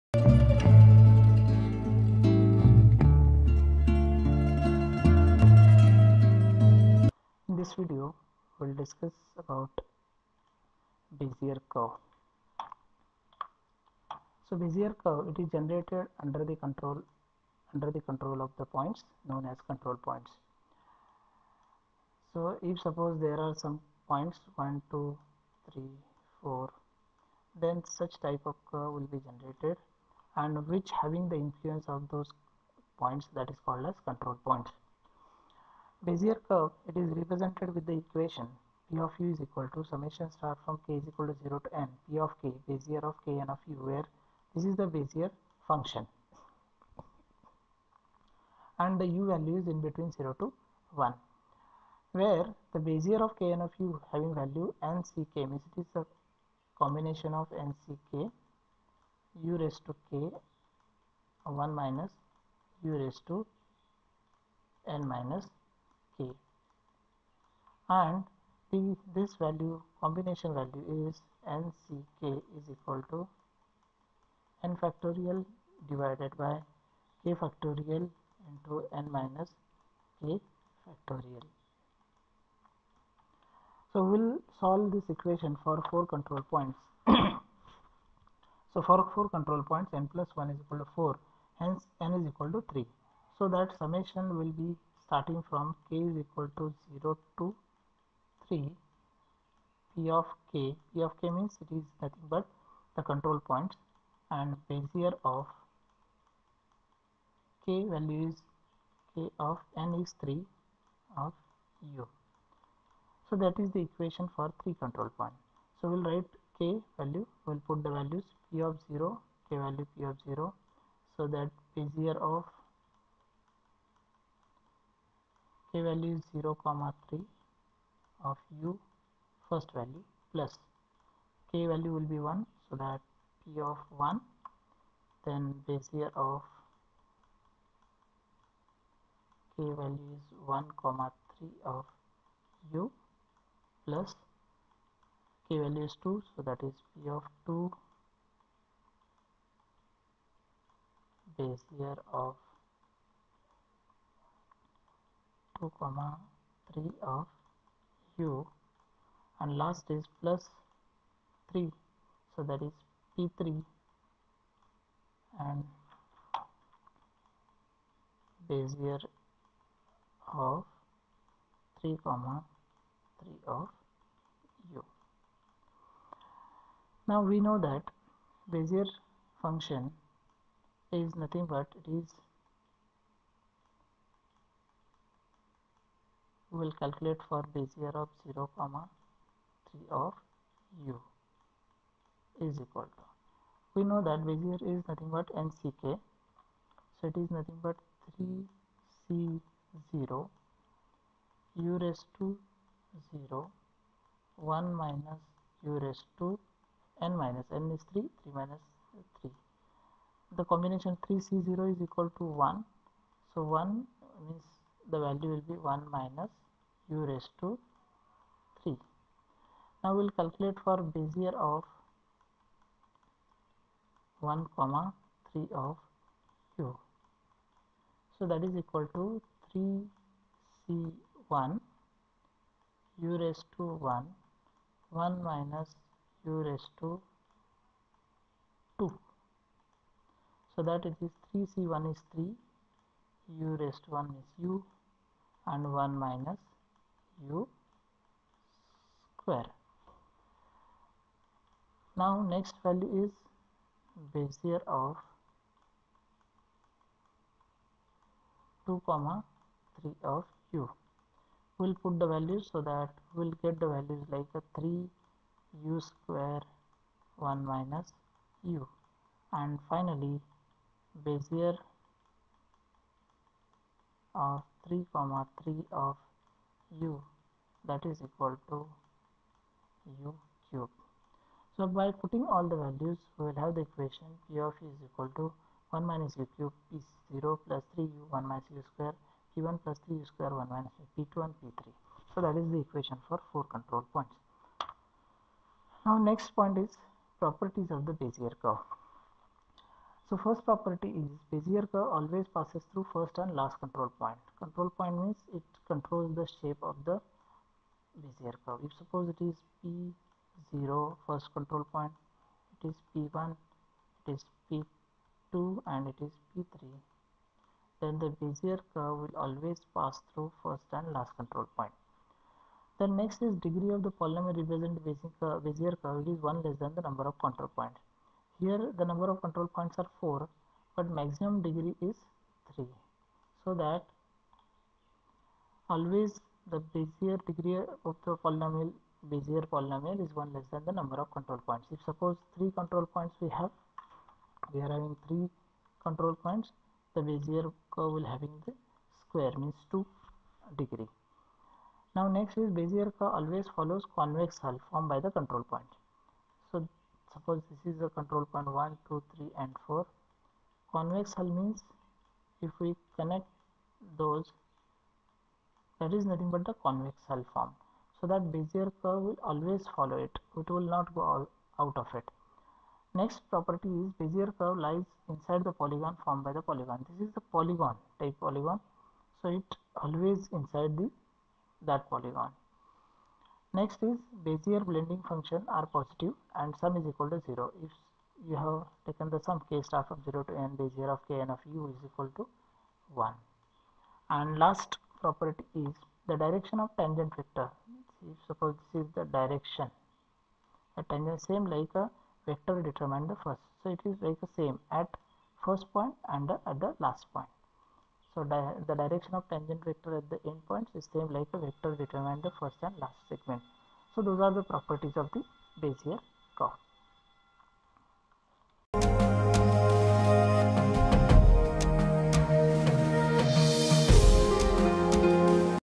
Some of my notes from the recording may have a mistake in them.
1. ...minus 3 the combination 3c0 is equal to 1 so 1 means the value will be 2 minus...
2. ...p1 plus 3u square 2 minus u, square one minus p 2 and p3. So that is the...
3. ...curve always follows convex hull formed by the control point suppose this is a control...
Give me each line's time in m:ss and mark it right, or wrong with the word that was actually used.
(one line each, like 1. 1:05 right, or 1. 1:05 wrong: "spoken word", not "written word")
1. 3:28 wrong: "1", not "2"
2. 4:49 wrong: "1", not "2"
3. 5:52 right.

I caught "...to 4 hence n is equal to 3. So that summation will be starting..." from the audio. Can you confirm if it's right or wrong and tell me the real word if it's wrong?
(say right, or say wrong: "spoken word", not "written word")
right.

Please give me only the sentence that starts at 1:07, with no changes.
and the, this value combination value is nck is equal to n factorial divided by k factorial into n minus k factorial.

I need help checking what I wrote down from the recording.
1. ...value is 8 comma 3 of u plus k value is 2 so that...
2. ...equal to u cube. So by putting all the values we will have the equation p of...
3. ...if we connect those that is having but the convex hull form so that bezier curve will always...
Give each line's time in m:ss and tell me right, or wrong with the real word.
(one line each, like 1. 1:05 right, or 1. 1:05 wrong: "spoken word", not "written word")
1. 2:19 wrong: "1", not "8"
2. 4:38 right
3. 6:02 wrong: "nothing", not "having".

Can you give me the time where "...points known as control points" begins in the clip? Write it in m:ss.
0:18.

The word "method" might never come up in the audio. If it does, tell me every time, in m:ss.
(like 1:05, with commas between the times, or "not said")
not said.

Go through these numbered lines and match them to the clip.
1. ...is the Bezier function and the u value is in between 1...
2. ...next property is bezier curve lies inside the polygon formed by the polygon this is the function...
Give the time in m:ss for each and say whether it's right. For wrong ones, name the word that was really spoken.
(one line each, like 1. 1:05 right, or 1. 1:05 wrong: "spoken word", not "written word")
1. 0:44 wrong: "0", not "1"
2. 6:13 wrong: "polygon", not "function".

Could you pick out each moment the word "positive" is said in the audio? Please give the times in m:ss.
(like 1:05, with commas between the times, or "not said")
6:25.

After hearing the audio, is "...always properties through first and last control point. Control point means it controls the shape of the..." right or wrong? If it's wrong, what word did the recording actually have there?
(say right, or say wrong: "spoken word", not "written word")
wrong: "passes", not "properties".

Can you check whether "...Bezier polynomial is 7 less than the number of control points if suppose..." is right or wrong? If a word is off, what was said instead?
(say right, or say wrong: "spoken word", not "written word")
wrong: "1", not "7".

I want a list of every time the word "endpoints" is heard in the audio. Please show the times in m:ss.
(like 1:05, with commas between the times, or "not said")
6:50.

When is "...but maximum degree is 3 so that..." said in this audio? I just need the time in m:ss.
5:30.